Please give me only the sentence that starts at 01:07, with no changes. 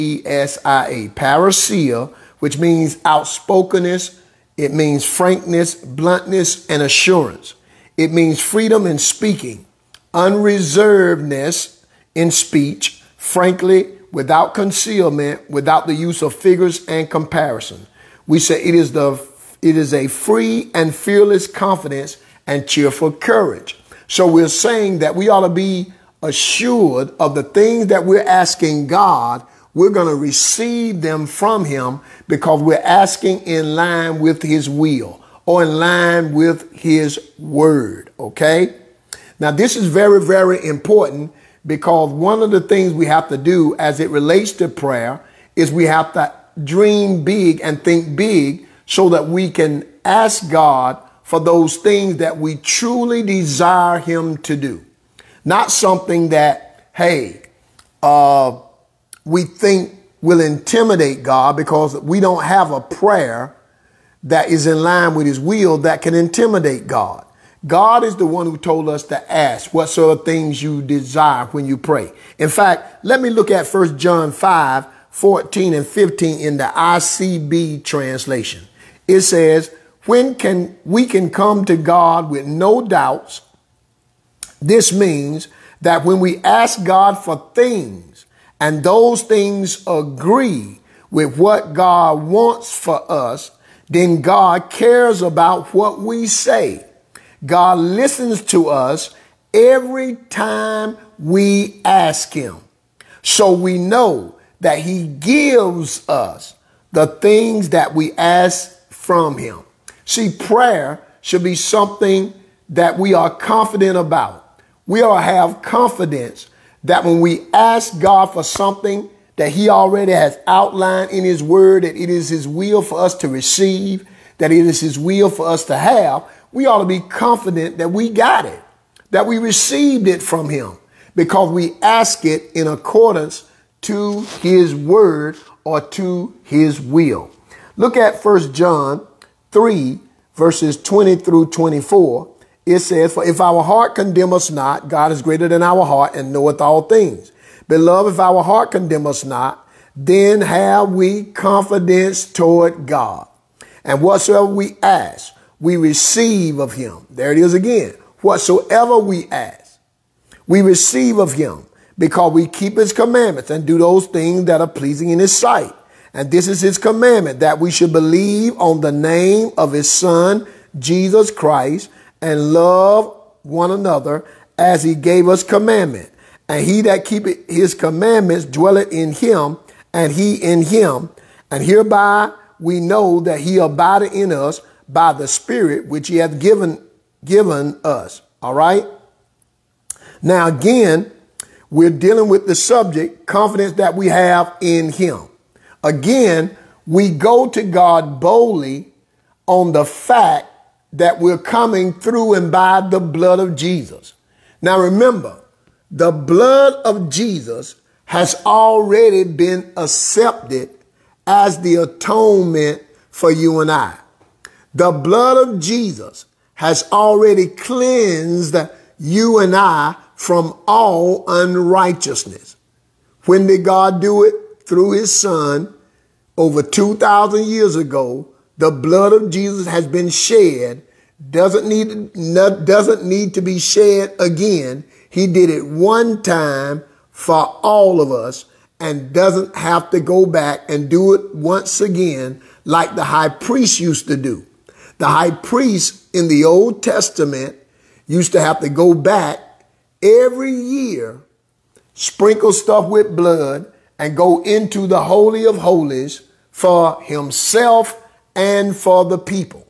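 God is the one who told us to ask what sort of things you desire when you pray.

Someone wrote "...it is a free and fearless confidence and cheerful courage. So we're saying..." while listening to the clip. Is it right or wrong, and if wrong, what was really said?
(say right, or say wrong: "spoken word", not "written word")
right.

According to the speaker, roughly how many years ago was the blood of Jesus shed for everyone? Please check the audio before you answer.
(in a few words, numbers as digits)
over 2,000.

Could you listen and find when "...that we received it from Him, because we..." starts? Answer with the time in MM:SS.
02:09.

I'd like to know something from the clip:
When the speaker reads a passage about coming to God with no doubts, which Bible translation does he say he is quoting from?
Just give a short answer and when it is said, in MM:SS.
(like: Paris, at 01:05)
ICB, at 01:16.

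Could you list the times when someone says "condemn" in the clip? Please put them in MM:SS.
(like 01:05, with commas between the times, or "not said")
02:23, 02:28.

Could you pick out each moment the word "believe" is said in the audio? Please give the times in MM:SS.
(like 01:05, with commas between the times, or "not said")
02:47.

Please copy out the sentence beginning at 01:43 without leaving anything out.
So we know that He gives us the things that we ask from Him.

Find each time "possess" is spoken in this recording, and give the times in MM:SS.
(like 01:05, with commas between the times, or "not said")
not said.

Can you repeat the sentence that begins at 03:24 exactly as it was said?
Now remember, the blood of Jesus has already been accepted as the atonement for you and I.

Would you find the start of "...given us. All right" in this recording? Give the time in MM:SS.
03:07.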